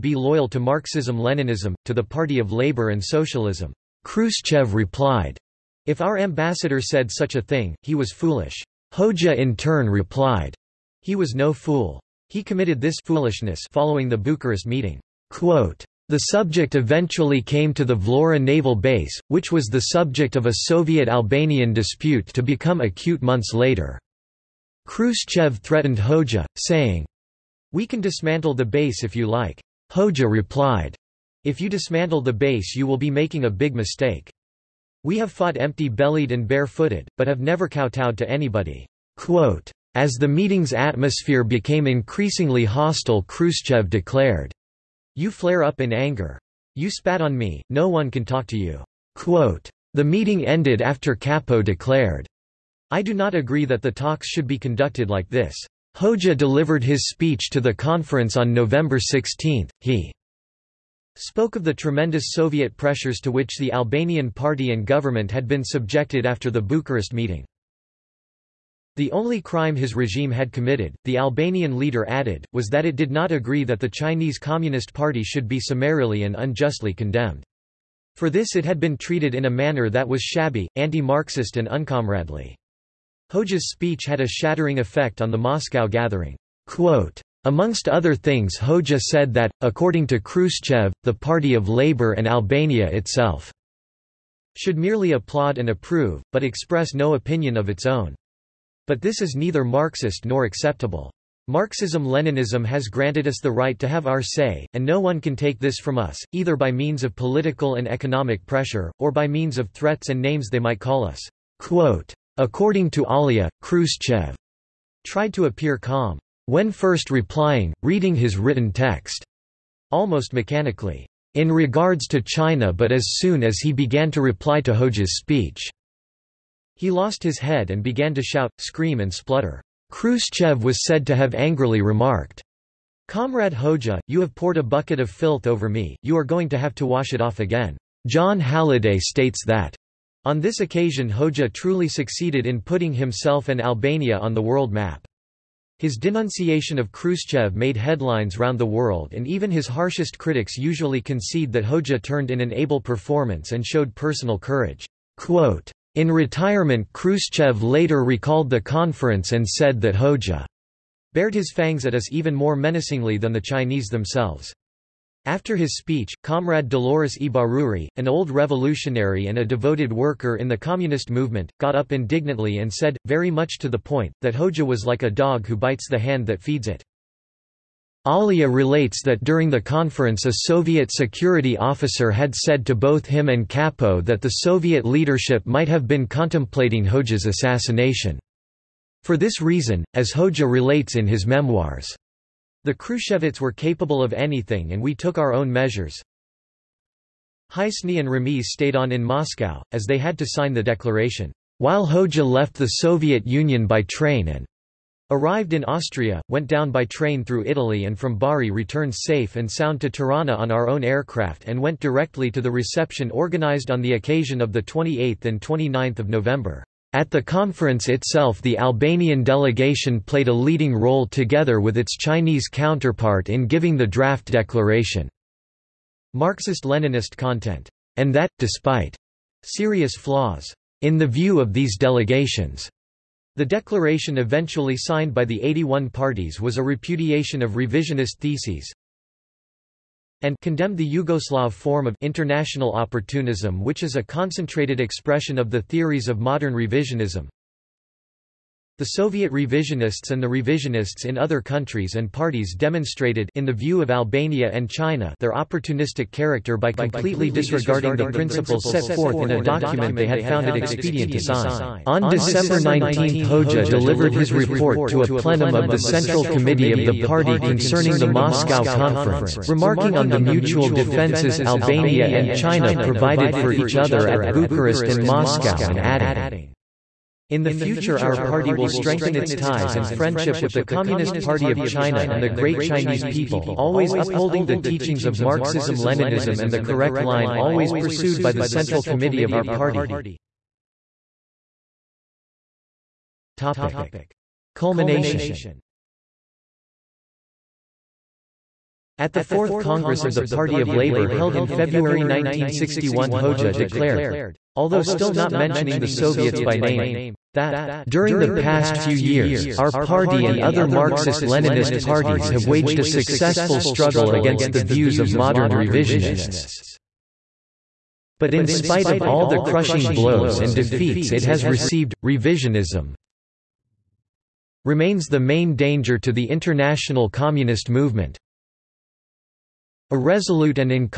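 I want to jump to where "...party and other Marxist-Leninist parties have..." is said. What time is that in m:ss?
5:09.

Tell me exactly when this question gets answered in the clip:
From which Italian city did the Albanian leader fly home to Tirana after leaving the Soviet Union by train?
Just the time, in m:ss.
3:28.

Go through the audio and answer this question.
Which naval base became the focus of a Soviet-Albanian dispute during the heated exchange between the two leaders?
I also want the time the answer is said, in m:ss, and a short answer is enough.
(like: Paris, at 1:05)
Vlora, at 0:17.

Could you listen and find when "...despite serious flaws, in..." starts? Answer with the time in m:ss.
3:48.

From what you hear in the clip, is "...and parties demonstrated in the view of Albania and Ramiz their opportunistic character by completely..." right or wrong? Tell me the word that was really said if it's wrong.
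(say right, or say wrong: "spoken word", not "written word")
wrong: "China", not "Ramiz".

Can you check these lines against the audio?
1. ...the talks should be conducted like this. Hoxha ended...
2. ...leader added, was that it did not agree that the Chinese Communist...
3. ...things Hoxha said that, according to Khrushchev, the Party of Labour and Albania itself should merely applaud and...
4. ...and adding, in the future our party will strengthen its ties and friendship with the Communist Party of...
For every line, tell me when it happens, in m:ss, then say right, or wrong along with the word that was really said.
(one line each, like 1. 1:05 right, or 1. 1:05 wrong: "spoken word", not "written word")
1. 0:53 wrong: "delivered", not "ended"
2. 1:11 right
3. 1:28 right
4. 4:35 right.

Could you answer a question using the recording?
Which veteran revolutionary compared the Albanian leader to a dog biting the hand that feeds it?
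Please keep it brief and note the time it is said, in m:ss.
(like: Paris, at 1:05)
Dolores Ibárruri, at 2:46.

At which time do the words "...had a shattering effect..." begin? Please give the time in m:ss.
1:24.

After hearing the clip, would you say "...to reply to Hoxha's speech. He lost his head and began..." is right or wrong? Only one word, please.
right.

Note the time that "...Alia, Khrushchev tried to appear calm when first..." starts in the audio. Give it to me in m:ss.
1:53.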